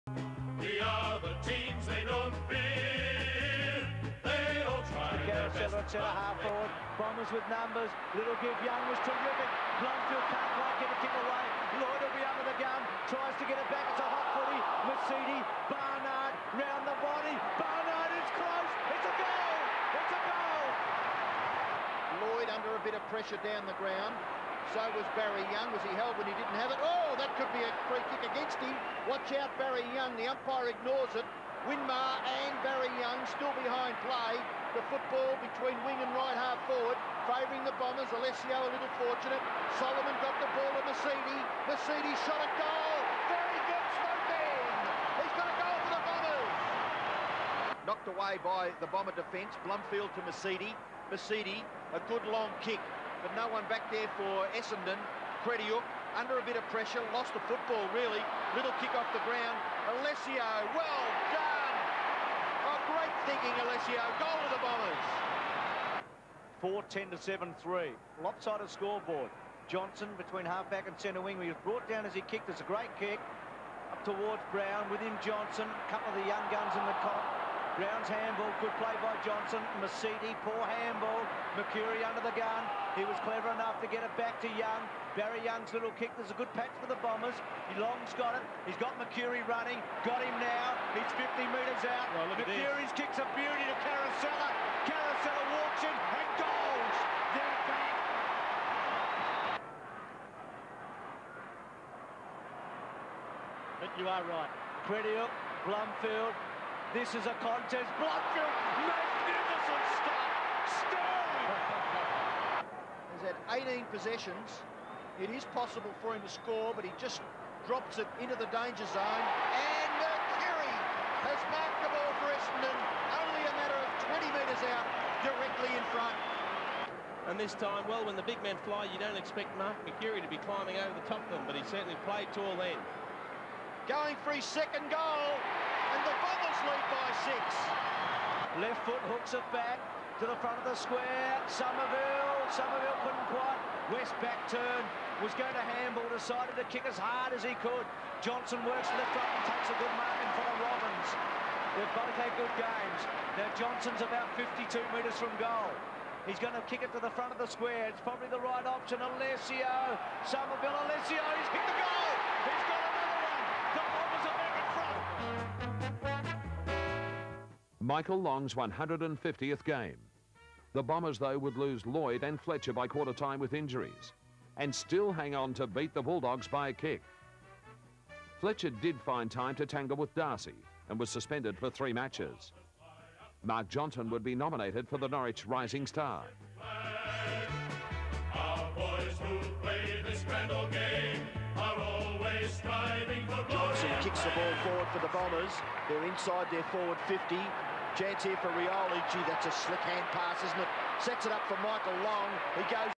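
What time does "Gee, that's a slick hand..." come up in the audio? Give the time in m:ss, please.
3:19.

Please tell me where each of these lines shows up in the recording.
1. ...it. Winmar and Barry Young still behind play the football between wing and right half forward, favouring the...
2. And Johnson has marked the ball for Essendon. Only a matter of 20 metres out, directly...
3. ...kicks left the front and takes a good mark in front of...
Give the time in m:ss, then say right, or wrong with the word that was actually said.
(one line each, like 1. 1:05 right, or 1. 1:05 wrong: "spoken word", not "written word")
1. 0:31 right
2. 1:59 wrong: "Kerry", not "Johnson"
3. 2:28 wrong: "works", not "kicks".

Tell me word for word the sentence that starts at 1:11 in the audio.
He was brought down as he kicked.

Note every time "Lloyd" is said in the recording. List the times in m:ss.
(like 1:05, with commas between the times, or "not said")
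0:11, 0:22, 2:51.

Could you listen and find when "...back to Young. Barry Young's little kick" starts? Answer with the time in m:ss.
1:24.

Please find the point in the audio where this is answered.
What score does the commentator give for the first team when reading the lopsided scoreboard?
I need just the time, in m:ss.
1:06.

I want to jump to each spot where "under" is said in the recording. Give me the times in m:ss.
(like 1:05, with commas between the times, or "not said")
0:12, 0:22, 0:56, 1:22.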